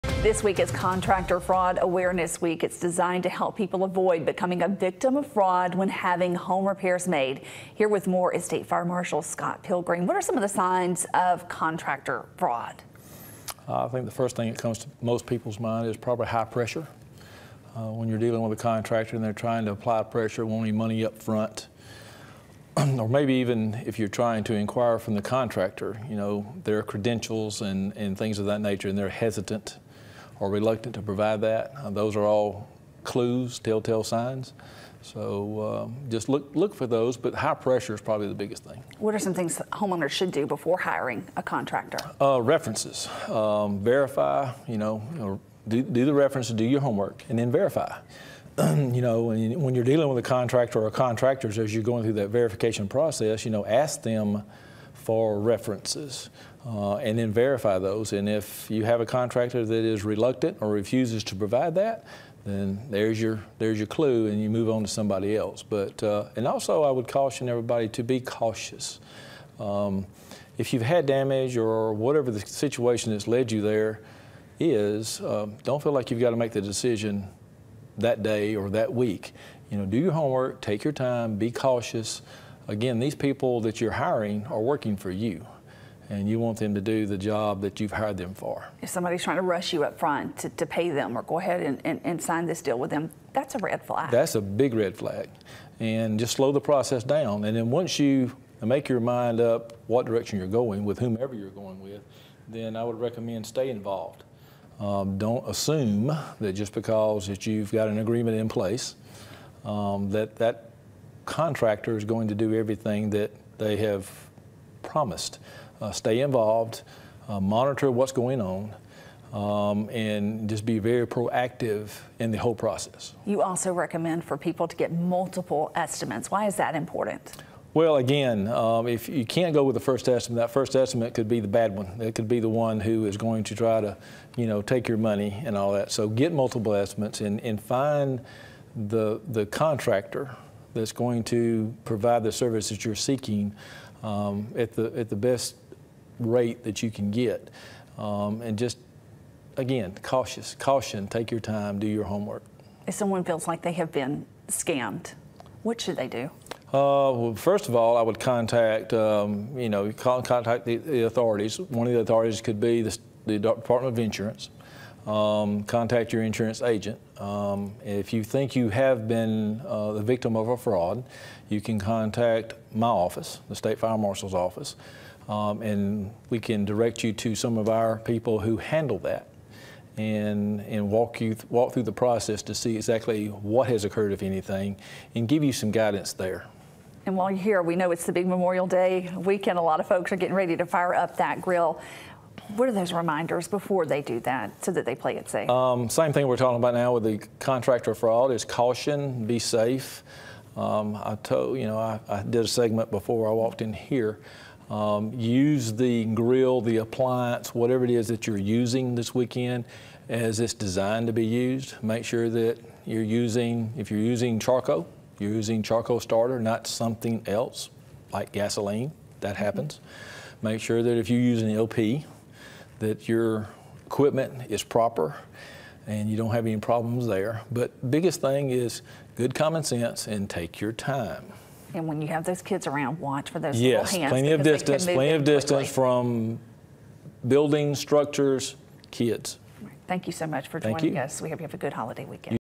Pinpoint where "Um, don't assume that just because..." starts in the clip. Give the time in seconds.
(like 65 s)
104 s.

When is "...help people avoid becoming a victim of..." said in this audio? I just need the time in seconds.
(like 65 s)
3 s.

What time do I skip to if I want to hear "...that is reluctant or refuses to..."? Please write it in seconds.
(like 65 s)
59 s.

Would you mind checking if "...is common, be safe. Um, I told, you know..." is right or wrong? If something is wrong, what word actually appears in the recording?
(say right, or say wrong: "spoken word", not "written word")
wrong: "caution", not "common".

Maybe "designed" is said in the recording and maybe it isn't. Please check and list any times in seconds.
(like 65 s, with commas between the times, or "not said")
2 s, 210 s.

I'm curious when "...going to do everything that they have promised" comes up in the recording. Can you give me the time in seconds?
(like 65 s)
112 s.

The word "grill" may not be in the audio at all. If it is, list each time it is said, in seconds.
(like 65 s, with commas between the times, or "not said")
191 s, 206 s.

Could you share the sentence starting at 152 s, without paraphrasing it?
If someone feels like they have been scammed, what should they do?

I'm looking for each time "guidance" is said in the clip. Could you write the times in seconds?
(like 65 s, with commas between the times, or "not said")
185 s.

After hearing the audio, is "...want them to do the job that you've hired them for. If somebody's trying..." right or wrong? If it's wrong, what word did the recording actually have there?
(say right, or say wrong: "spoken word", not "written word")
right.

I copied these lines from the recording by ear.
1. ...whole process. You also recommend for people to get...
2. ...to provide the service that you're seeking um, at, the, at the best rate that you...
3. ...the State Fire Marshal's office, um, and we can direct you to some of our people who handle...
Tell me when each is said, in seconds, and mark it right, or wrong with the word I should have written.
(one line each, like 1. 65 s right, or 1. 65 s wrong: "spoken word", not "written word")
1. 122 s right
2. 141 s right
3. 173 s right.